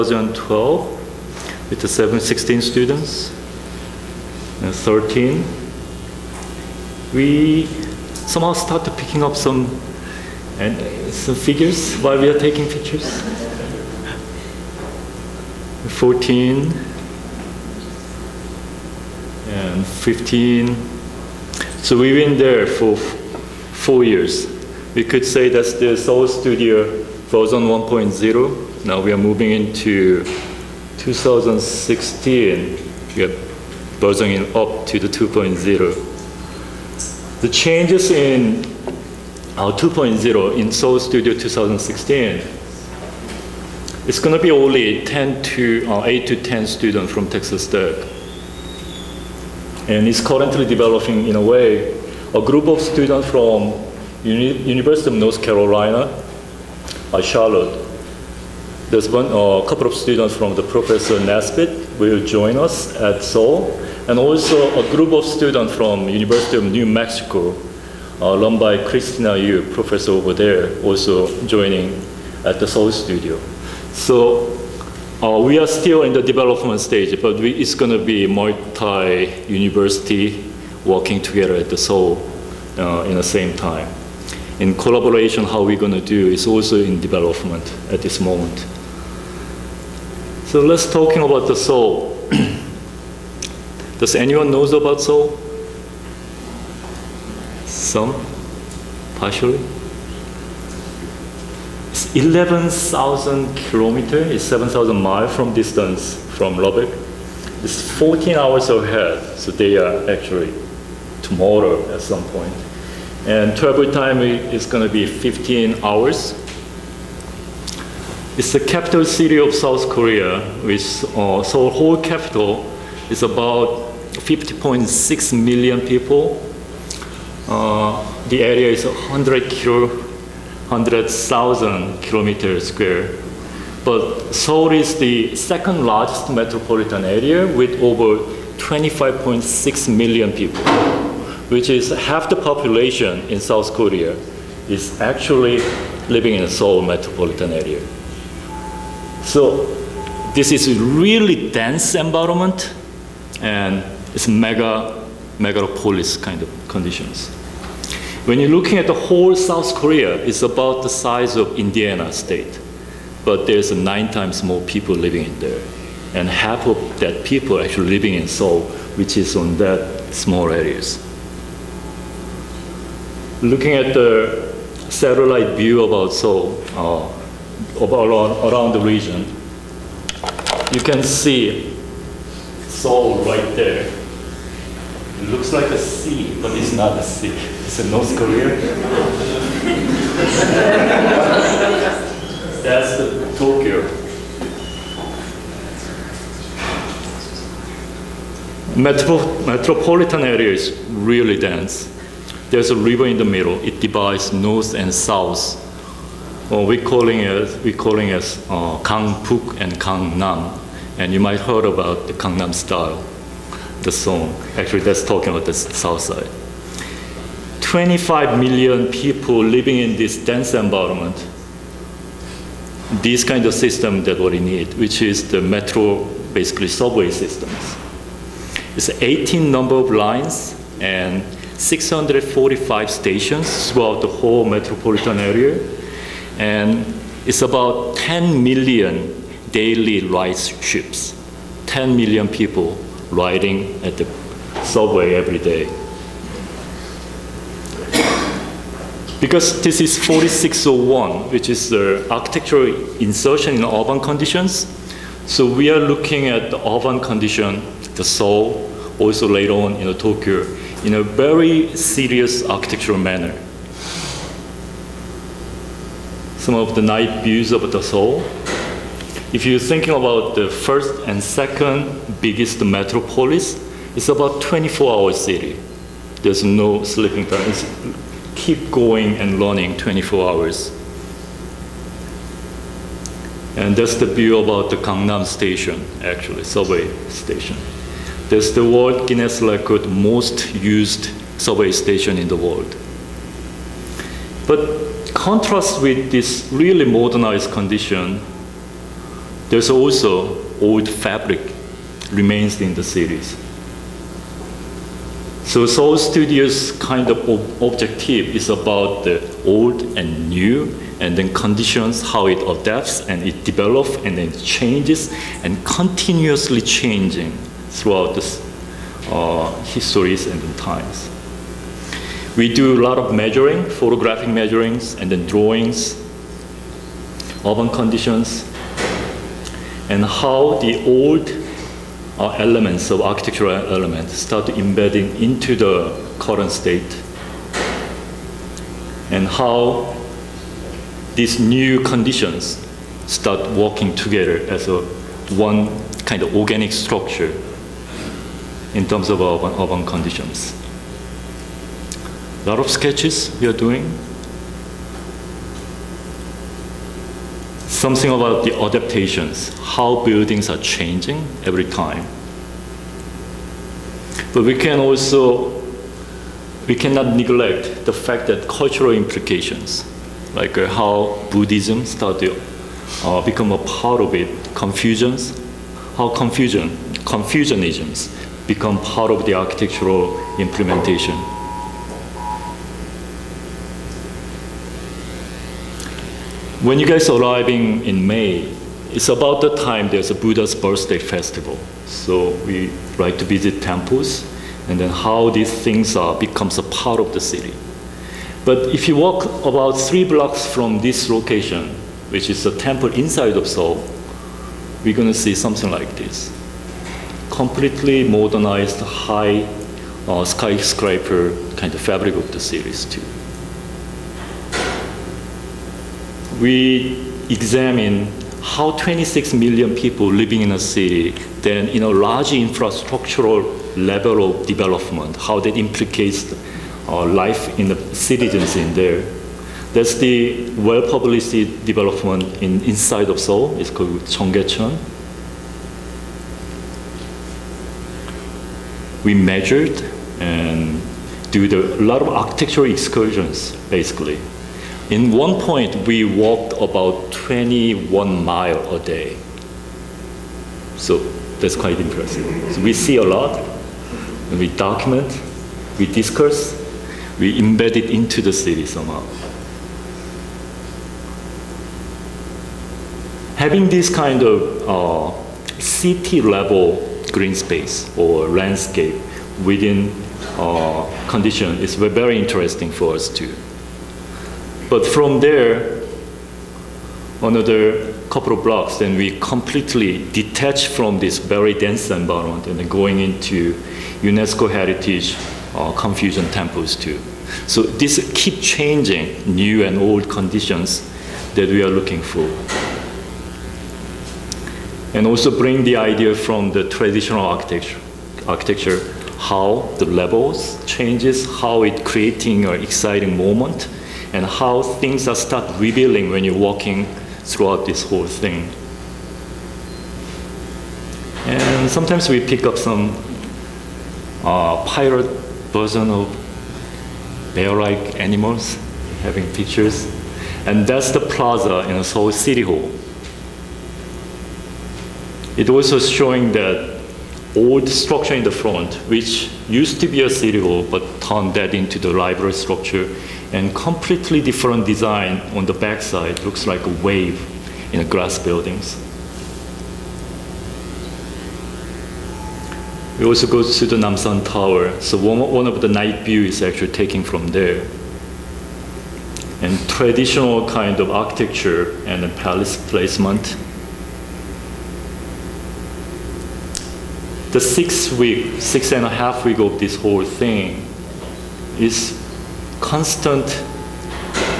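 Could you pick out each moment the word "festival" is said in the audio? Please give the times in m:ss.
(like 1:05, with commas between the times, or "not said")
6:30.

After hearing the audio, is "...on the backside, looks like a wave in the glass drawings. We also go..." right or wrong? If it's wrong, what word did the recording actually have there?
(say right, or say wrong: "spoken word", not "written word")
wrong: "buildings", not "drawings".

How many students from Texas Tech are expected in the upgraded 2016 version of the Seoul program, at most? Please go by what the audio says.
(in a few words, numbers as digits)
10.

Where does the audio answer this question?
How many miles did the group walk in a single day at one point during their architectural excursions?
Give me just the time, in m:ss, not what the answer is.
7:27.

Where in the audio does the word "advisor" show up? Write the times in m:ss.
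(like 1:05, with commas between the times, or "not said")
not said.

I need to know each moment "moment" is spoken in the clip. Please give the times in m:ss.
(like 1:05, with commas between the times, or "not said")
1:28, 8:23.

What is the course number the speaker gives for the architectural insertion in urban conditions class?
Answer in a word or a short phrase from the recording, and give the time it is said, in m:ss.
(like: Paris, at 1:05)
4601, at 4:10.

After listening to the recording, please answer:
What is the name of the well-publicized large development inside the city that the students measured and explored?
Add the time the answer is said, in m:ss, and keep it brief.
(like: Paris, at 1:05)
Cheonggyecheon, at 7:14.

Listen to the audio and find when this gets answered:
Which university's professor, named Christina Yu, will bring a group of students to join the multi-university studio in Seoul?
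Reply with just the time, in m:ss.
1:06.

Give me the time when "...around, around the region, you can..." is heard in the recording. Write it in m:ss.
2:58.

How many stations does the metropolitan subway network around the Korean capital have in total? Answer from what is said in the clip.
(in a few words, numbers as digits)
645.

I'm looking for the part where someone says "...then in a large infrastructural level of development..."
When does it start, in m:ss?
7:01.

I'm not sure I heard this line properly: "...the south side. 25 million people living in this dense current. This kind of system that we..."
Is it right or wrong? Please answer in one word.
wrong.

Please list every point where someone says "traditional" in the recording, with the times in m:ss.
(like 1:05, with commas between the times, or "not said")
8:16, 9:09.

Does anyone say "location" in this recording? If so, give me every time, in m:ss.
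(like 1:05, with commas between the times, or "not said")
6:41.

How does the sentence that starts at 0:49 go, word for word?
And it's currently developing in a way a group of students from Uni University of North Carolina, uh, Charlotte.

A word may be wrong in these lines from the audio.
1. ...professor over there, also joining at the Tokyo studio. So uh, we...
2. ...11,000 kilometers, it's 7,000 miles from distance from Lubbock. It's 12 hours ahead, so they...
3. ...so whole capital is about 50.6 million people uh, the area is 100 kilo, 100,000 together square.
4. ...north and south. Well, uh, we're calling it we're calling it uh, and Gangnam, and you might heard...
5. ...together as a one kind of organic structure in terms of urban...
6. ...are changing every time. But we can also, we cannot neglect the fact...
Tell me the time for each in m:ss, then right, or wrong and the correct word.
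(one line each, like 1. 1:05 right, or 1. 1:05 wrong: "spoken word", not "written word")
1. 1:09 wrong: "Seoul", not "Tokyo"
2. 1:42 wrong: "14", not "12"
3. 2:01 wrong: "kilometer", not "together"
4. 3:24 right
5. 5:43 right
6. 6:00 right.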